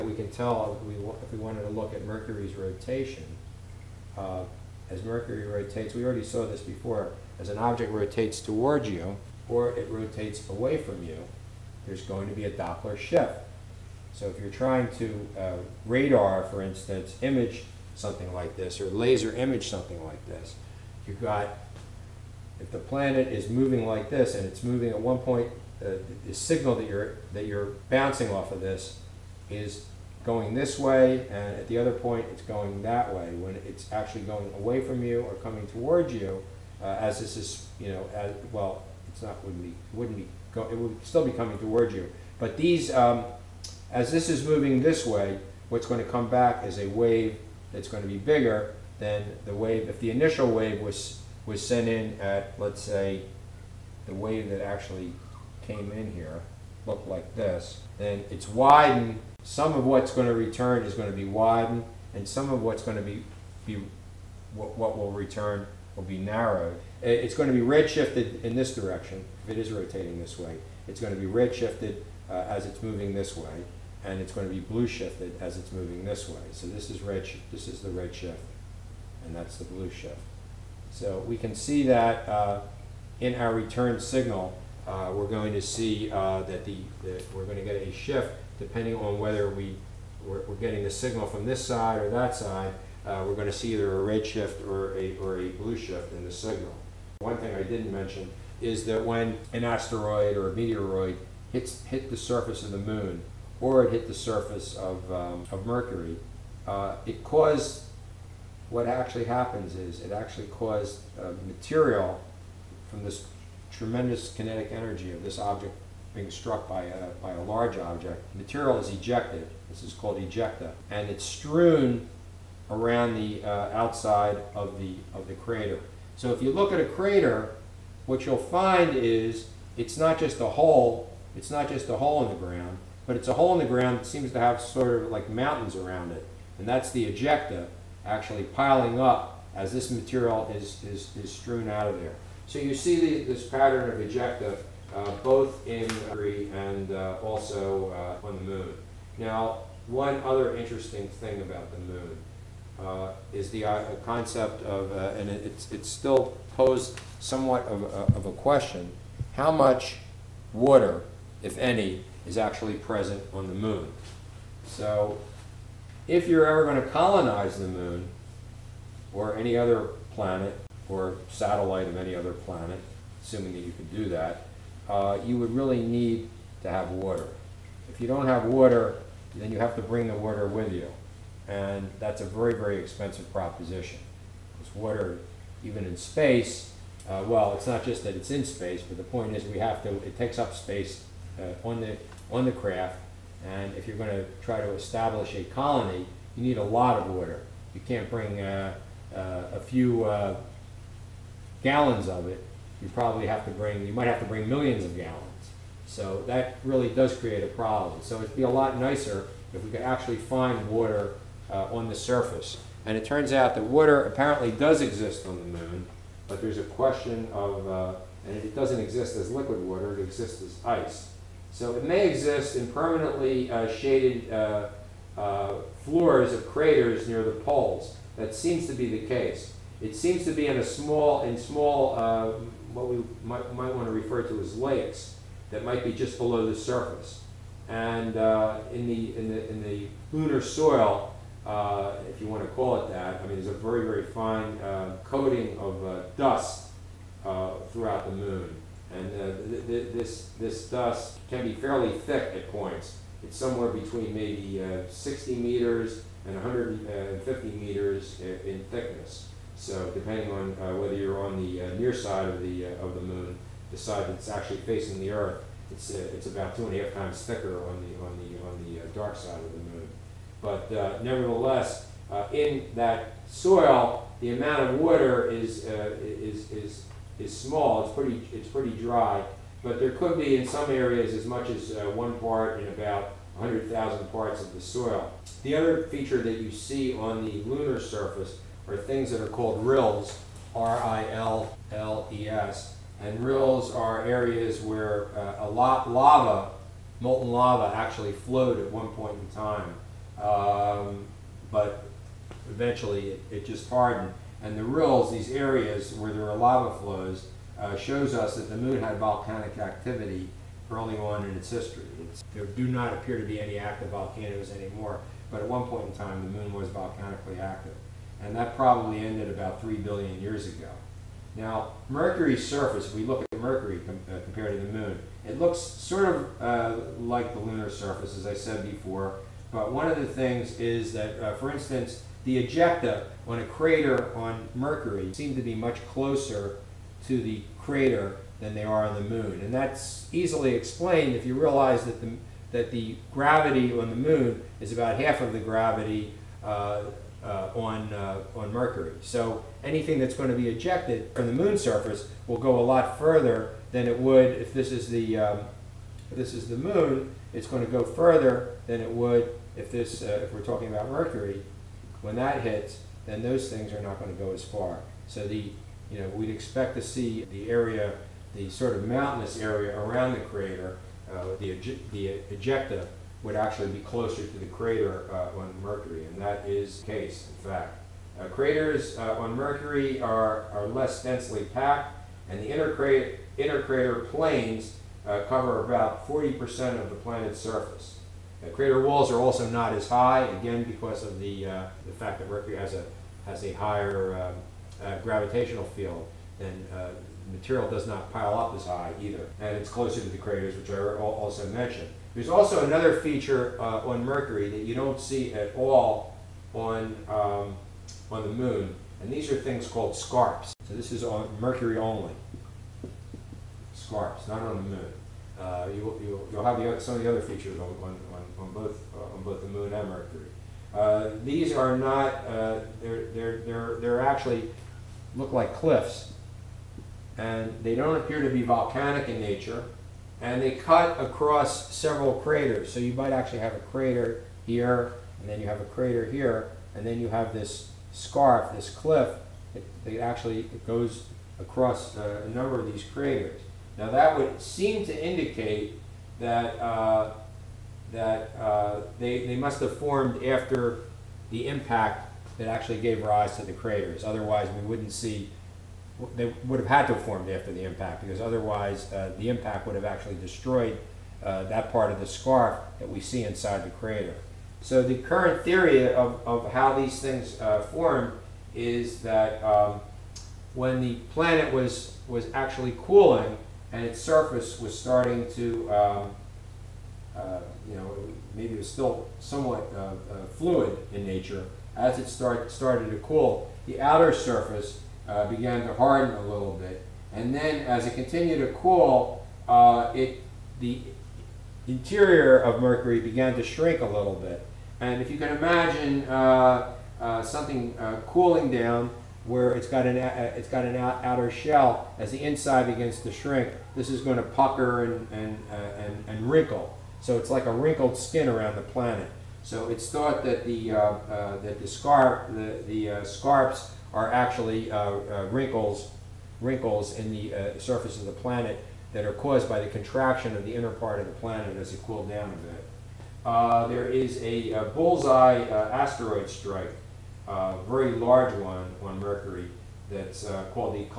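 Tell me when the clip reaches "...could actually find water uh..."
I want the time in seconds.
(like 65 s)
209 s.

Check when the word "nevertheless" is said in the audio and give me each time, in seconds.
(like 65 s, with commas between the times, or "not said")
271 s.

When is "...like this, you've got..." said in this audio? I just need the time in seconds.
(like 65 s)
20 s.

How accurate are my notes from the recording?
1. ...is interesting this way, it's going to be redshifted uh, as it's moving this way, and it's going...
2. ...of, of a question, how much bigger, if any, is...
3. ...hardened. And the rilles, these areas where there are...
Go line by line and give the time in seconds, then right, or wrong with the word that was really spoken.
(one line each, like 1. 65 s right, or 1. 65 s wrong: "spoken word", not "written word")
1. 69 s wrong: "rotating", not "interesting"
2. 157 s wrong: "water", not "bigger"
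3. 303 s right.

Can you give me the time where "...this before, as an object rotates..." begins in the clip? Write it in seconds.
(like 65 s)
6 s.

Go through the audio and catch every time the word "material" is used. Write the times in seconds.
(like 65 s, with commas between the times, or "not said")
111 s, 118 s, 139 s, 397 s.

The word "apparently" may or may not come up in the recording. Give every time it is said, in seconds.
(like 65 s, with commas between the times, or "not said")
214 s.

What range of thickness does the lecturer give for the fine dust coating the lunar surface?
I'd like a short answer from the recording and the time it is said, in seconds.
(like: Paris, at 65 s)
60 to 150 meters, at 253 s.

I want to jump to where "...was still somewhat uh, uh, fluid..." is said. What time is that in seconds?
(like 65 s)
478 s.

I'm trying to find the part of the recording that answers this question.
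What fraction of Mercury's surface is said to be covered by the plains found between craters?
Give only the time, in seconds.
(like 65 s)
385 s.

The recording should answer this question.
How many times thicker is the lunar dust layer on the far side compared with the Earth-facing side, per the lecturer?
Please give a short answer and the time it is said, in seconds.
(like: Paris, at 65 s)
2.5 times, at 266 s.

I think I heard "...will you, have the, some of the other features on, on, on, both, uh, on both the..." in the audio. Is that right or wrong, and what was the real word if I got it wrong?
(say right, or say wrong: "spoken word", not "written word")
right.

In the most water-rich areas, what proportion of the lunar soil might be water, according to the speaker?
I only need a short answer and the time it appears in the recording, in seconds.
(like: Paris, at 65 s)
1 part in 100,000, at 281 s.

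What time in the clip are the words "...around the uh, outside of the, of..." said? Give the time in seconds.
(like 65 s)
122 s.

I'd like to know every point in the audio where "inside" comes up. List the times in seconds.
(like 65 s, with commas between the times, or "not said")
463 s, 502 s.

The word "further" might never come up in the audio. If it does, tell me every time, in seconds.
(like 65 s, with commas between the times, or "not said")
352 s, 357 s.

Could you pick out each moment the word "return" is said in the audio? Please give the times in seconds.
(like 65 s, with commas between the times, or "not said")
60 s, 65 s, 83 s.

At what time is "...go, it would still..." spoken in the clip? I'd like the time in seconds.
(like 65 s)
40 s.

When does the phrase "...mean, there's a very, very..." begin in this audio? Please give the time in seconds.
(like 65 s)
243 s.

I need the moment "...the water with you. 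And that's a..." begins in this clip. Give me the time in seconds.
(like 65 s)
180 s.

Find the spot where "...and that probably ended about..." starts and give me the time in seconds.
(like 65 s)
318 s.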